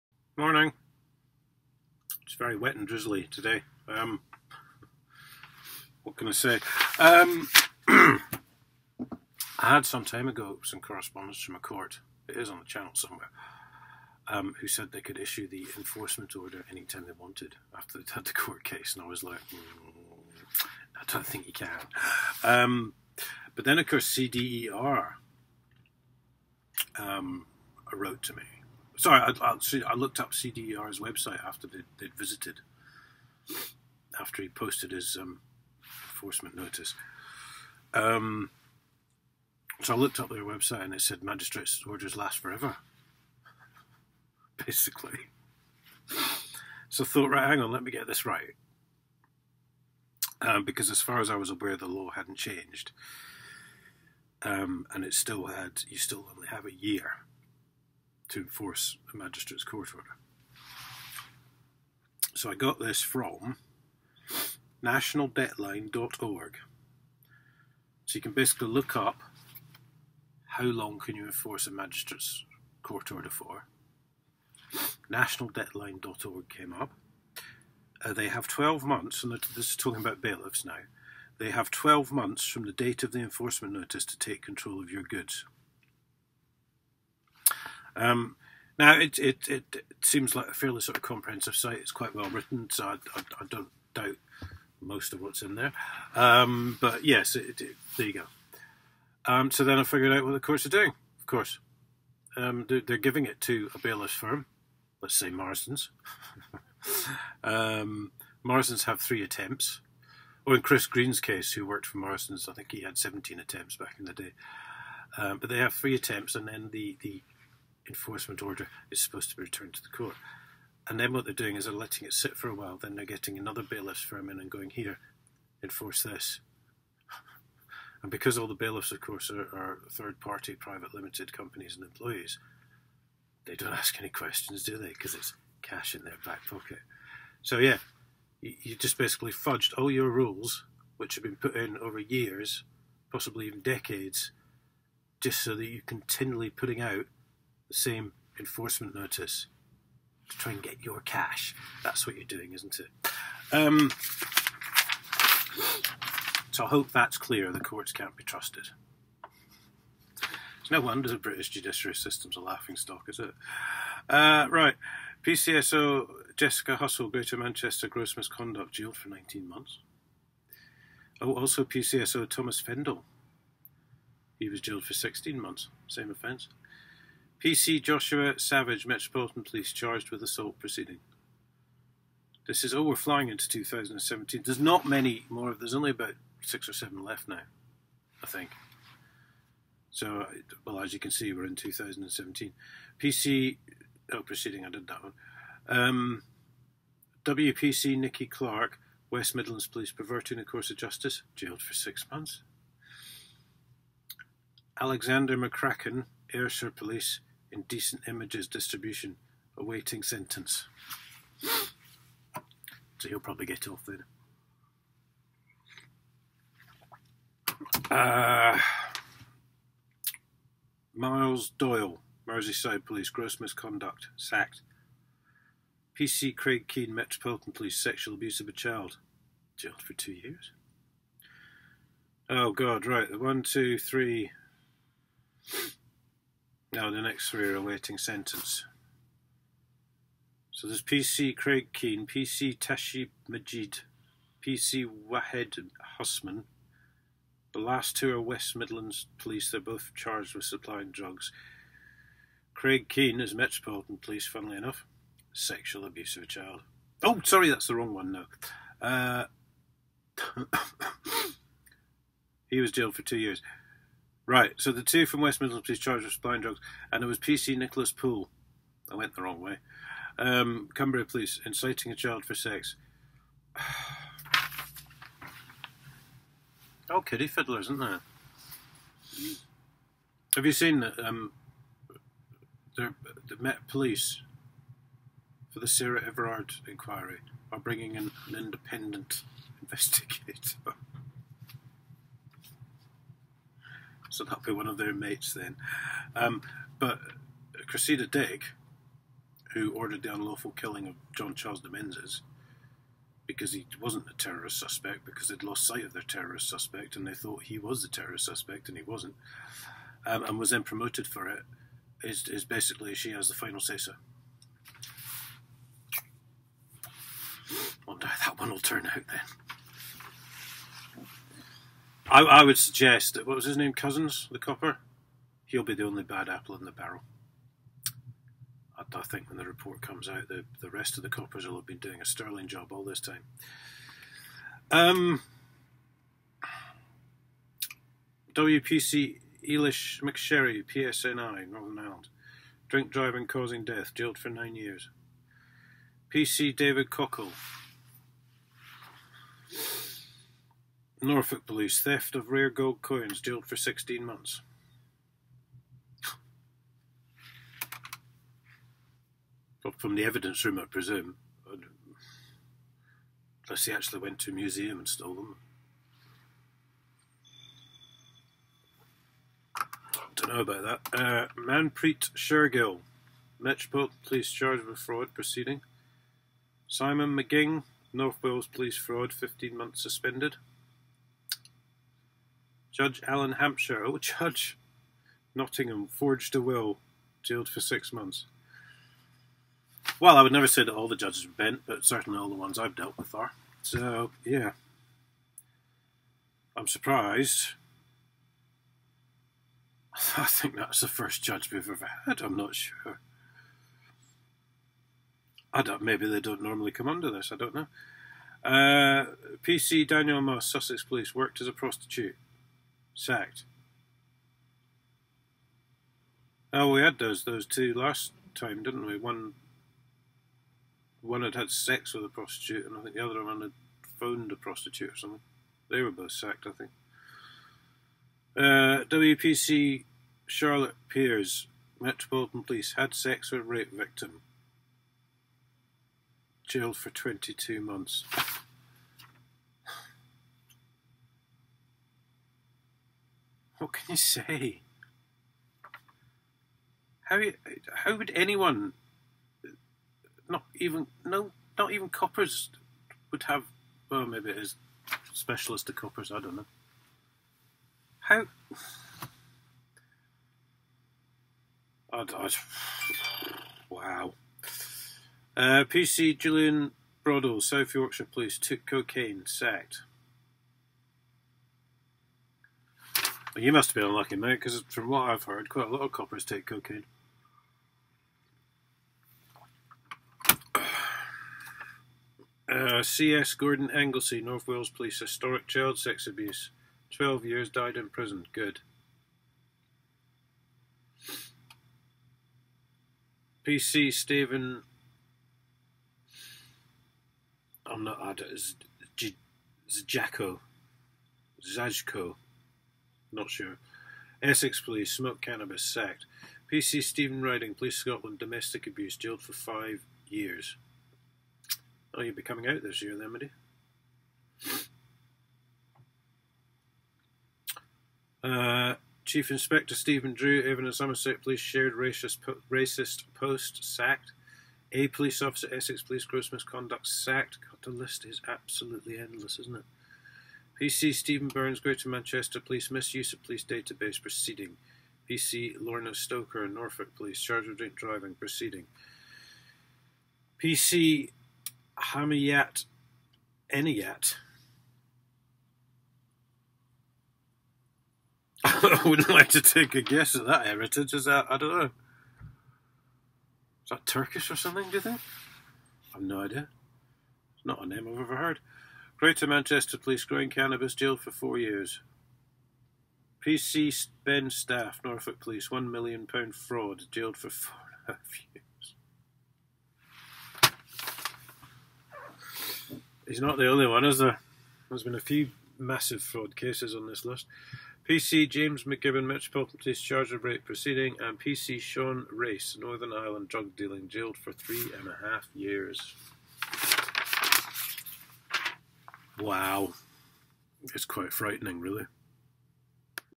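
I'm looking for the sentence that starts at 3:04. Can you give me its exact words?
There's not many more, there's only about six or seven left now, I think.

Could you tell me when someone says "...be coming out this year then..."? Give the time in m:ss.
8:32.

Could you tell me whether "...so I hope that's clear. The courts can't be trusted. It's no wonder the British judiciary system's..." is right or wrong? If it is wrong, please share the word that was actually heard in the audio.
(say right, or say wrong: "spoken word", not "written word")
right.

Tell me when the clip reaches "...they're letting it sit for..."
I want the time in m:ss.
2:01.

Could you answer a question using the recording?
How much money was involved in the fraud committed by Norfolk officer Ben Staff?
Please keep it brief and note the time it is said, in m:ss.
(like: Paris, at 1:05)
£1 million, at 9:25.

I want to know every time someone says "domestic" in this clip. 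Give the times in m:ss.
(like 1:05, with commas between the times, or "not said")
8:28.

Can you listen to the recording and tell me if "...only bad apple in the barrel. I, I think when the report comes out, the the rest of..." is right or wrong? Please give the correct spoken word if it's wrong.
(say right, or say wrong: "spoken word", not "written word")
right.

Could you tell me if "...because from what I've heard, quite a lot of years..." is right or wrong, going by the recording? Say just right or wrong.
wrong.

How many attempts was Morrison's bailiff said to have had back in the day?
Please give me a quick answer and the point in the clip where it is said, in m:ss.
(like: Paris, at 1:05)
17, at 1:52.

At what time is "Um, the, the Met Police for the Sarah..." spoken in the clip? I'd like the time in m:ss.
4:40.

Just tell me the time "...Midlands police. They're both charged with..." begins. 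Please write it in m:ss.
4:08.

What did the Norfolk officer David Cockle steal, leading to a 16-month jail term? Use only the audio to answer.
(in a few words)
rare gold coins.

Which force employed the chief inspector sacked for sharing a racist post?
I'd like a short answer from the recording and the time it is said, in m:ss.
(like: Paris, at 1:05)
Avon and Somerset Police, at 8:40.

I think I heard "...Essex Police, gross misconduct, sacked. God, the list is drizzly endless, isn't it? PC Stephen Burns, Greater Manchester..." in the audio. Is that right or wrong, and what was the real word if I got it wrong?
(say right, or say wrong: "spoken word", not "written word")
wrong: "absolutely", not "drizzly".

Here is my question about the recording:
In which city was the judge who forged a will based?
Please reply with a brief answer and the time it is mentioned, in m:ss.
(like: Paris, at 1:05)
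Nottingham, at 6:25.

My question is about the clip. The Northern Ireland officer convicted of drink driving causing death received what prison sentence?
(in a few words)
9 years.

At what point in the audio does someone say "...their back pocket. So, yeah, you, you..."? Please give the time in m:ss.
2:16.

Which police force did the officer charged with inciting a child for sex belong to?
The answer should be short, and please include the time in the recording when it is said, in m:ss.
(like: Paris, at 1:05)
Cumbria Police, at 4:30.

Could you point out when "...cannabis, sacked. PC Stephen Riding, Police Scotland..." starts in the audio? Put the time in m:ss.
8:25.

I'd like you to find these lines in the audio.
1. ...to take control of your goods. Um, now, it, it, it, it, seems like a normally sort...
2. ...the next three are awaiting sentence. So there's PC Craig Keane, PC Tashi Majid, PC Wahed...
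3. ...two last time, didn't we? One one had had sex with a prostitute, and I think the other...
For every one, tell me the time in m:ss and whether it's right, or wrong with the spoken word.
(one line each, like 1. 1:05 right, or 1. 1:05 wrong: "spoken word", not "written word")
1. 1:24 wrong: "fairly", not "normally"
2. 3:56 right
3. 6:57 right.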